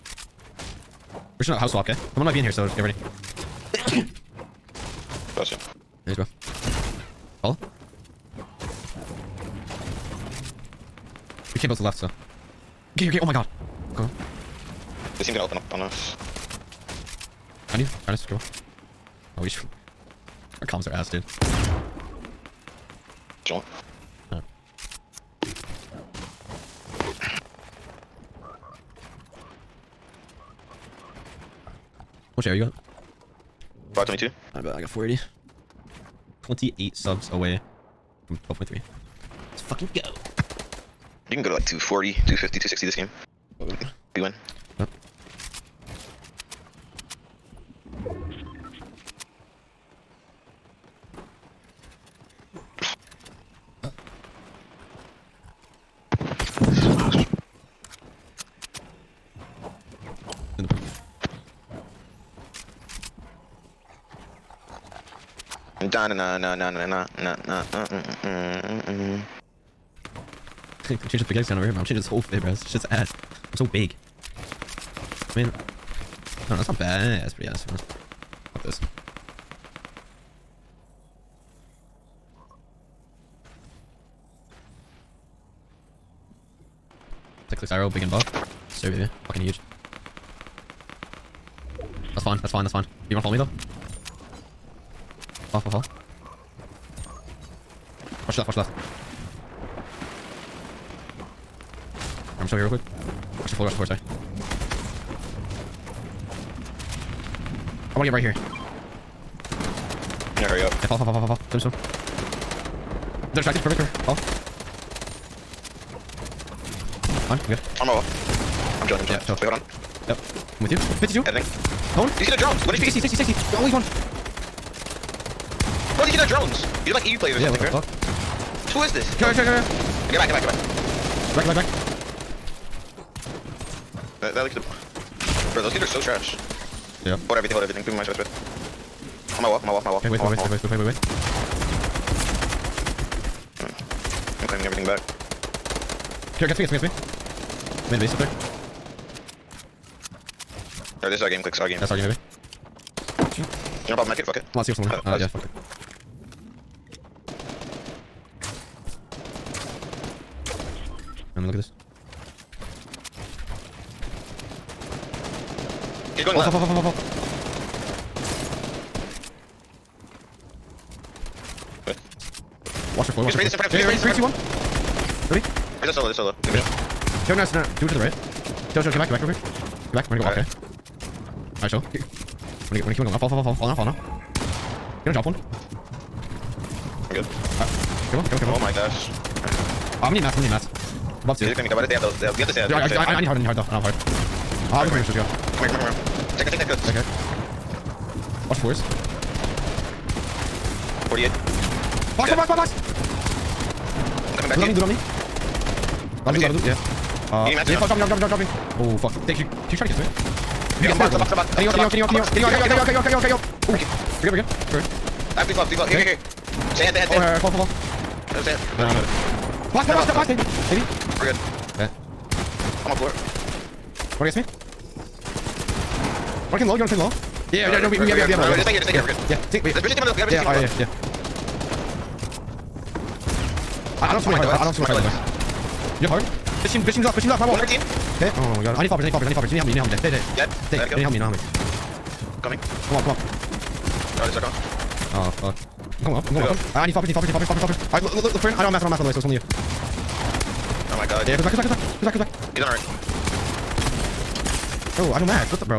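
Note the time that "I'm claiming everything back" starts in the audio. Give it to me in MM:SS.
02:24.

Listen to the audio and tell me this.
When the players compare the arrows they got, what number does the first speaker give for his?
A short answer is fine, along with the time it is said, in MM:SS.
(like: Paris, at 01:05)
522, at 00:33.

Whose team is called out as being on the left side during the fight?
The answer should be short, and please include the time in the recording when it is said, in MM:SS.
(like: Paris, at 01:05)
Bishop's team, at 03:49.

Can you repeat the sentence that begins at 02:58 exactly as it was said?
Kill, show, get back, get back real Get back, we're gonna go All off, right.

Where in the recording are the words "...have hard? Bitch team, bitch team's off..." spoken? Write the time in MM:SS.
03:56.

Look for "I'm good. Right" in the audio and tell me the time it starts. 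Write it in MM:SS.
03:07.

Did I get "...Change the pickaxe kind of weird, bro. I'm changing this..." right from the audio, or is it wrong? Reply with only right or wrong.
right.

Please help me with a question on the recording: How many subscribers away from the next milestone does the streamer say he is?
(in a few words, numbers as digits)
28.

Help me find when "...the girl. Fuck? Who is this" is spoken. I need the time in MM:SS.
02:07.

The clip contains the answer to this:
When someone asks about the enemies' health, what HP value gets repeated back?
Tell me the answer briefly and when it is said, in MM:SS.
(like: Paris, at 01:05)
60, at 02:02.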